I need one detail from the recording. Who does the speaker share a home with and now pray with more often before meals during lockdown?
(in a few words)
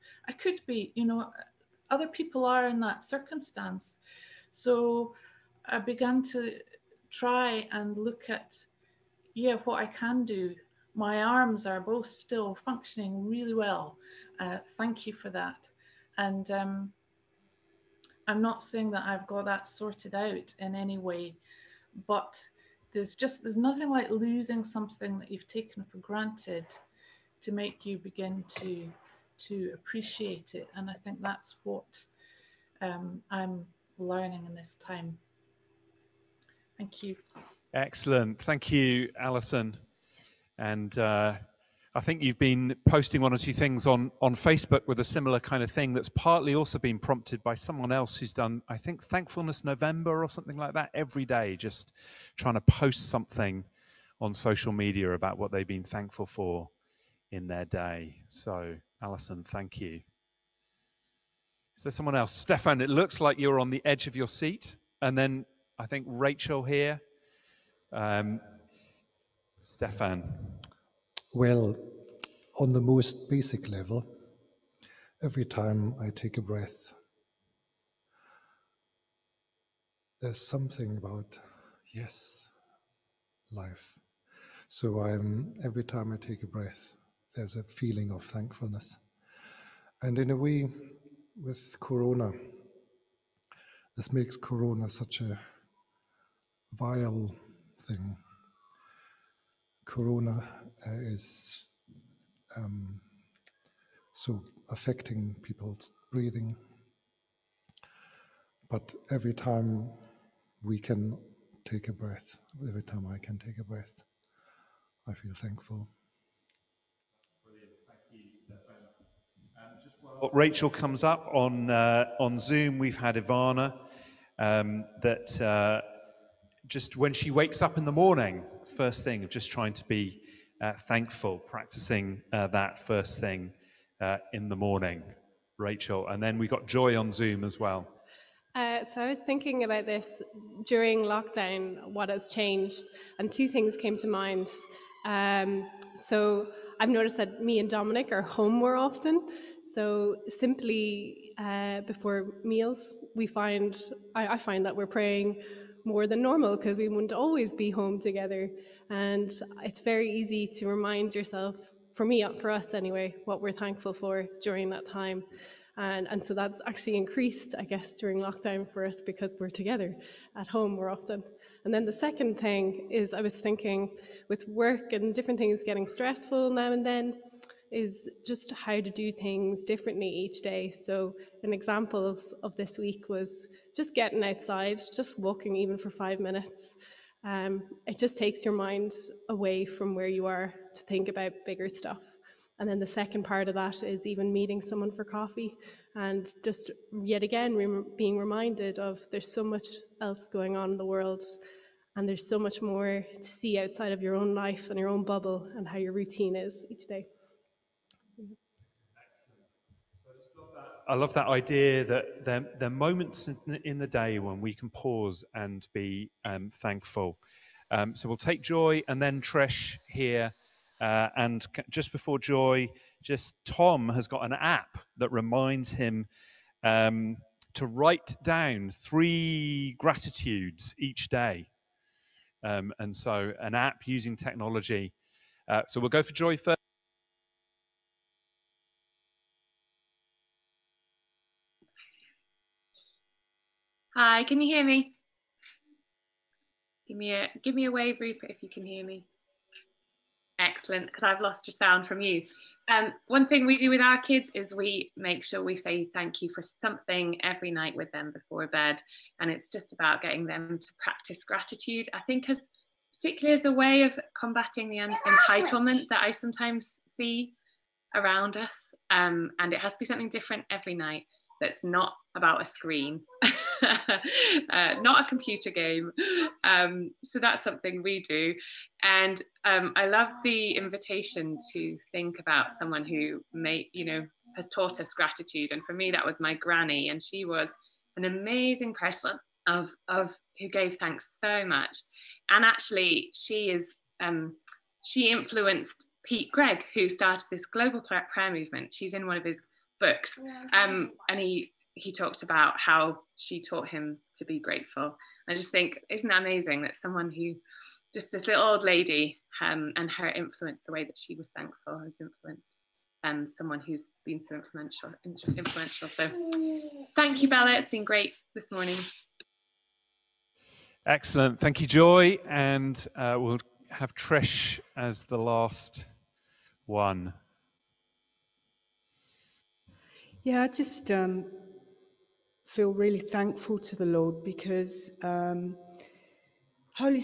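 Dominic.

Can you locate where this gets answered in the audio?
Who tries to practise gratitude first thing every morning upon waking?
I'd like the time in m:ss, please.
2:03.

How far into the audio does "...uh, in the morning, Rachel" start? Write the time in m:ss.
2:13.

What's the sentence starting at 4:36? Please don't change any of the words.
Um, so that's something we do.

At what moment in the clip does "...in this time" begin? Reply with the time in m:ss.
0:34.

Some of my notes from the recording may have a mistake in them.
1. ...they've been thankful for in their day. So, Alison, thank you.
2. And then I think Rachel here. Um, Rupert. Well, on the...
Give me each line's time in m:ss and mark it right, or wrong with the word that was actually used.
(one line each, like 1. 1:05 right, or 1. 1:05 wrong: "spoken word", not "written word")
1. 0:55 right
2. 1:05 wrong: "Stefan", not "Rupert".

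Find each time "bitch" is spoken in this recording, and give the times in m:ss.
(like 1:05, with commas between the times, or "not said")
not said.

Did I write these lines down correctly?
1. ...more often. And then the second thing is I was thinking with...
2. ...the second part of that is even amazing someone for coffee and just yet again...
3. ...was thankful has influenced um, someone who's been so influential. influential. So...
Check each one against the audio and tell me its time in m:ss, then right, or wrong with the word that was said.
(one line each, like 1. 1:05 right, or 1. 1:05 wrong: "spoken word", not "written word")
1. 2:50 right
2. 3:12 wrong: "meeting", not "amazing"
3. 5:11 right.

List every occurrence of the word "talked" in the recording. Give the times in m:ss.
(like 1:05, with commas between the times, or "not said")
5:01.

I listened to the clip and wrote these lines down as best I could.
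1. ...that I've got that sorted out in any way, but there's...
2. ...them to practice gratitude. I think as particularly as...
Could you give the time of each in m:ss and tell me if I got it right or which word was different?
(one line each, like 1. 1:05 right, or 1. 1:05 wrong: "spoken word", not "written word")
1. 0:18 right
2. 4:20 right.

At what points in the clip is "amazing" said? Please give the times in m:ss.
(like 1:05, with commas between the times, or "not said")
4:48, 5:06.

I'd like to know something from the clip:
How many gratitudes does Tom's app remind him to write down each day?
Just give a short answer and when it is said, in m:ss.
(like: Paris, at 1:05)
3, at 3:48.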